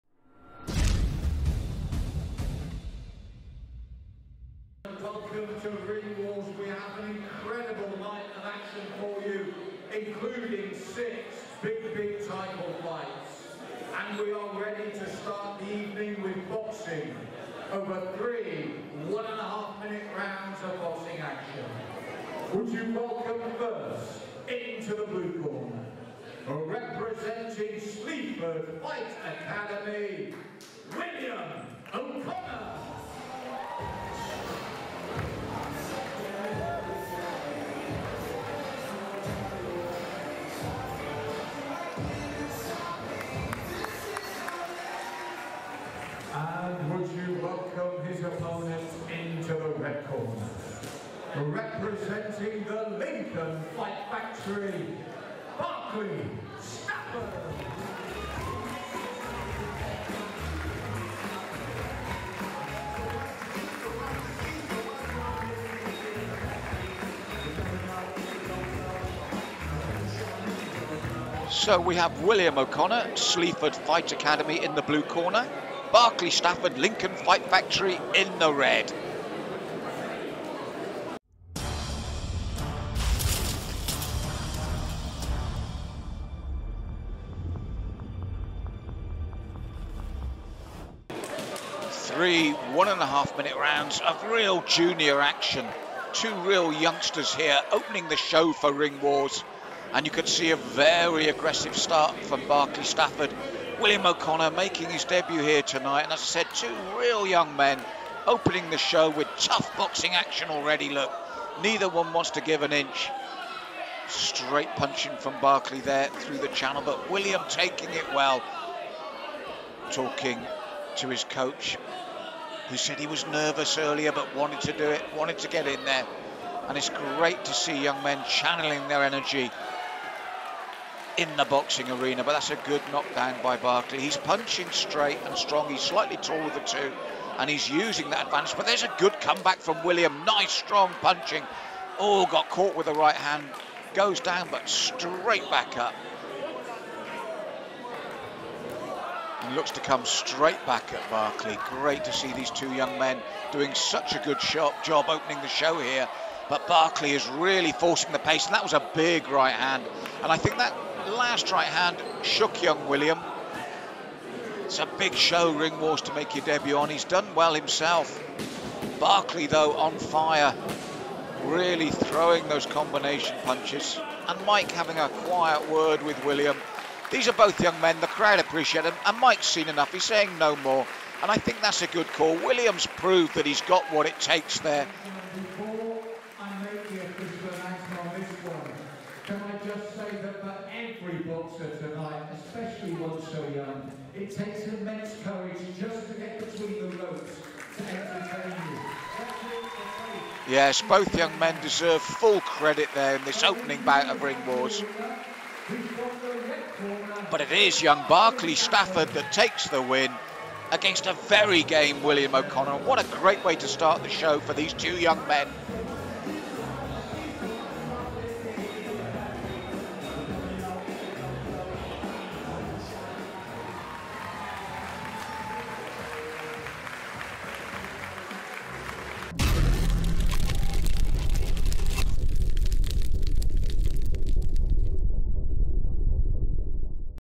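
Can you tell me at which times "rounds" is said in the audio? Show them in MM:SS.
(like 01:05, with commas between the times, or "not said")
00:20, 01:33.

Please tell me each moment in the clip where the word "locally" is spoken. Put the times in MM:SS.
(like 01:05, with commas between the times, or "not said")
not said.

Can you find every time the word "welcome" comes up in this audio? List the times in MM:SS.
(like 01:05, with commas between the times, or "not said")
00:22, 00:47.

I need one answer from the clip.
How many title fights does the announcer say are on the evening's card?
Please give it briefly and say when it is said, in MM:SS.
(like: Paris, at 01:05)
6, at 00:10.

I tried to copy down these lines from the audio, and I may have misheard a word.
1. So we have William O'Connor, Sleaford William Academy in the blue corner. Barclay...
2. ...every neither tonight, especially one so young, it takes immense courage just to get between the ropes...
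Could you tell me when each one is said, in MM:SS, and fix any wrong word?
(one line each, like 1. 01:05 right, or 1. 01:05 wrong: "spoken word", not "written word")
1. 01:11 wrong: "Fight", not "William"
2. 03:10 wrong: "boxer", not "neither".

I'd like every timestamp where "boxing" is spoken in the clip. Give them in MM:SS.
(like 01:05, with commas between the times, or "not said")
00:16, 00:20, 01:49, 02:11.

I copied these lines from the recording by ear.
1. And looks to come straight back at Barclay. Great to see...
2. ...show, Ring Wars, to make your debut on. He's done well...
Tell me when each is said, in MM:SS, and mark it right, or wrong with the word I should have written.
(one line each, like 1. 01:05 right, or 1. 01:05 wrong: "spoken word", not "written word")
1. 02:29 right
2. 02:45 right.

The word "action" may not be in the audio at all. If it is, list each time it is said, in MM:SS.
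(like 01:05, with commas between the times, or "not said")
00:08, 00:21, 01:35, 01:50.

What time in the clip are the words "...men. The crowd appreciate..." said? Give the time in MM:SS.
02:57.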